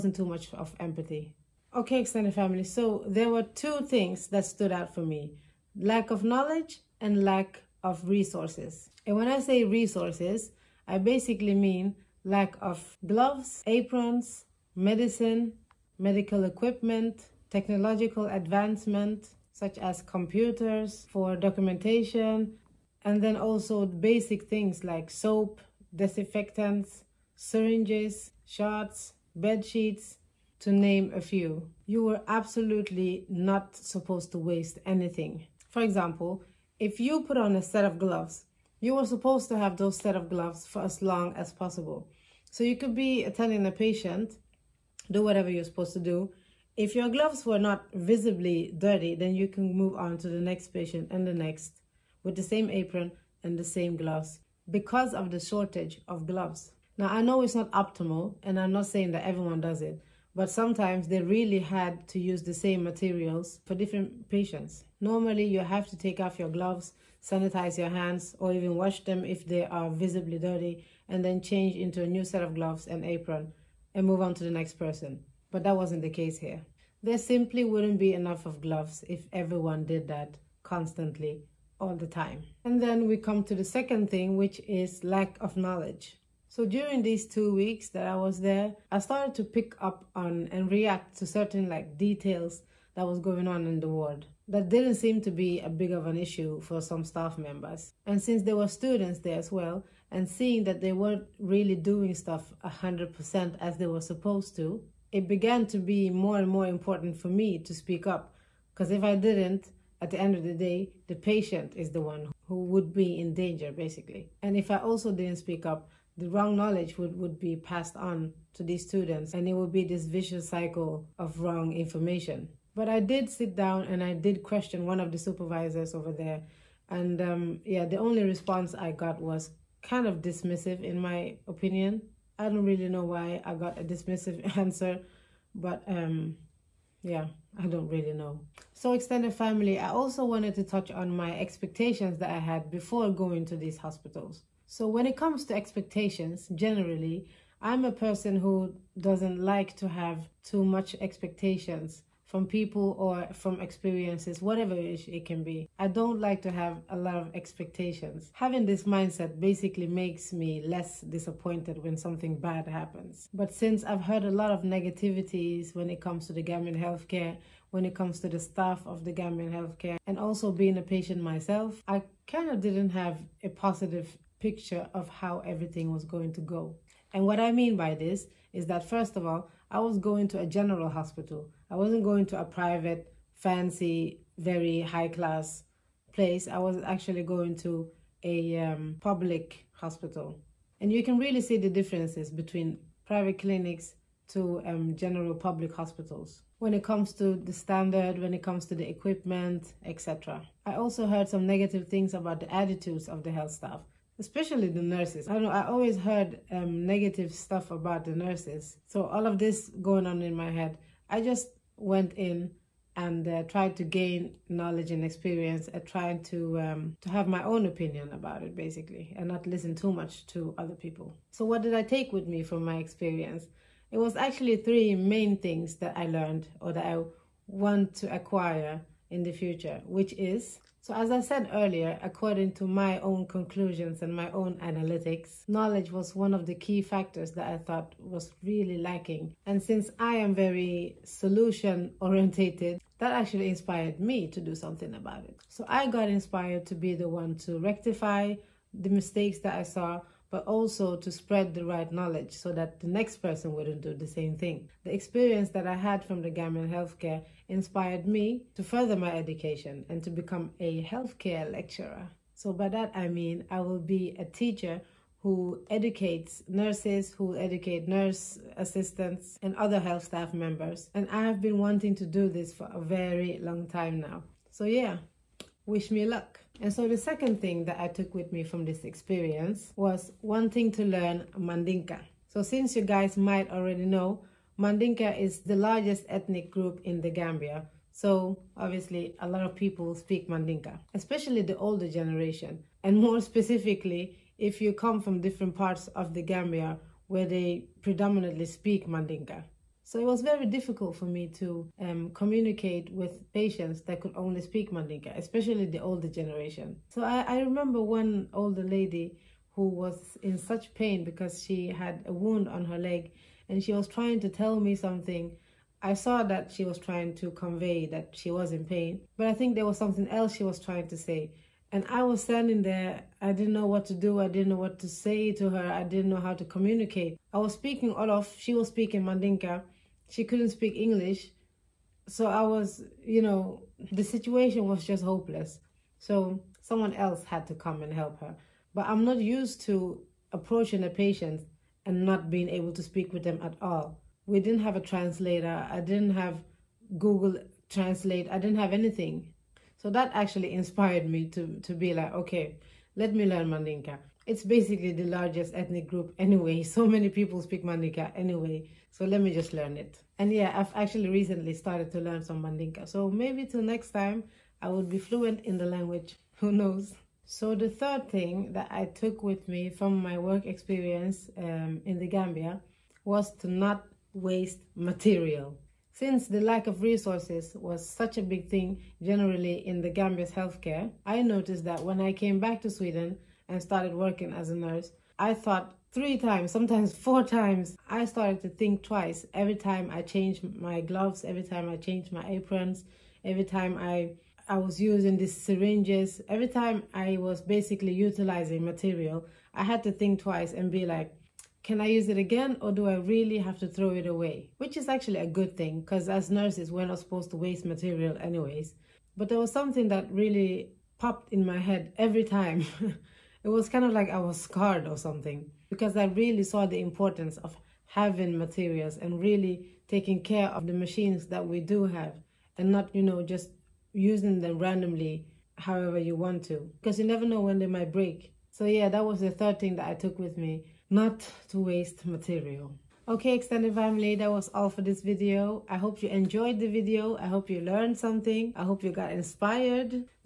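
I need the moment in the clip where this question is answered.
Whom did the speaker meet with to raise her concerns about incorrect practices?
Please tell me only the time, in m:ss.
2:04.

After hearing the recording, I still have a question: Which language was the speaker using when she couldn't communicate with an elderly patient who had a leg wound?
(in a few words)
Wolof.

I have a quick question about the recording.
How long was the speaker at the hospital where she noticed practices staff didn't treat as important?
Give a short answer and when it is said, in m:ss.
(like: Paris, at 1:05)
2 weeks, at 1:27.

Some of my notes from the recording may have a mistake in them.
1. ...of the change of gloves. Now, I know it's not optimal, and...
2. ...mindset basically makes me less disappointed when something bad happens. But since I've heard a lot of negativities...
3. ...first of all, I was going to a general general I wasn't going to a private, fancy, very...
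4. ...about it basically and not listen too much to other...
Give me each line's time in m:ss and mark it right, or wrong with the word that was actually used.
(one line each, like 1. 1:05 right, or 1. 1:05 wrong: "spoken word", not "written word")
1. 0:55 wrong: "shortage", not "change"
2. 2:38 right
3. 2:58 wrong: "hospital", not "general"
4. 3:38 right.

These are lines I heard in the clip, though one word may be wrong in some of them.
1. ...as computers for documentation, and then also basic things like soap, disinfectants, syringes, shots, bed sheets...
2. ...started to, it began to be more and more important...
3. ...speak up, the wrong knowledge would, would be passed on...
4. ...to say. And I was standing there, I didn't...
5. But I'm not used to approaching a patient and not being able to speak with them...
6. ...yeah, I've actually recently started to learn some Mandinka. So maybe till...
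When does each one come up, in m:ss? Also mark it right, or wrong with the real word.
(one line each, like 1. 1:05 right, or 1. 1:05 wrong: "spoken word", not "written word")
1. 0:19 right
2. 1:44 wrong: "supposed", not "started"
3. 1:55 right
4. 5:20 right
5. 5:38 right
6. 6:00 right.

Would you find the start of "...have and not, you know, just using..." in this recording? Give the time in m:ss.
7:01.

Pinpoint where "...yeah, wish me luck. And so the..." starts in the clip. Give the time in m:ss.
4:34.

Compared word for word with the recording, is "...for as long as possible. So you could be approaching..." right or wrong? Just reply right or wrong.
wrong.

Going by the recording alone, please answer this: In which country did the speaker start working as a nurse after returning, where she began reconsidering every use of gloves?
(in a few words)
Sweden.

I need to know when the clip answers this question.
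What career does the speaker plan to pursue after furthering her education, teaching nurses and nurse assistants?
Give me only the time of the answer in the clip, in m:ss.
4:20.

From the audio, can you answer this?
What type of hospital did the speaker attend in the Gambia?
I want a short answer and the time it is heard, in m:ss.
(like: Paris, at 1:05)
public hospital, at 3:08.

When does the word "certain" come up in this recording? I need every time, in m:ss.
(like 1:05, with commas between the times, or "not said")
1:31.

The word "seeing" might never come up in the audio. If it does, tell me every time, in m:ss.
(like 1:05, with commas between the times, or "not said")
1:40.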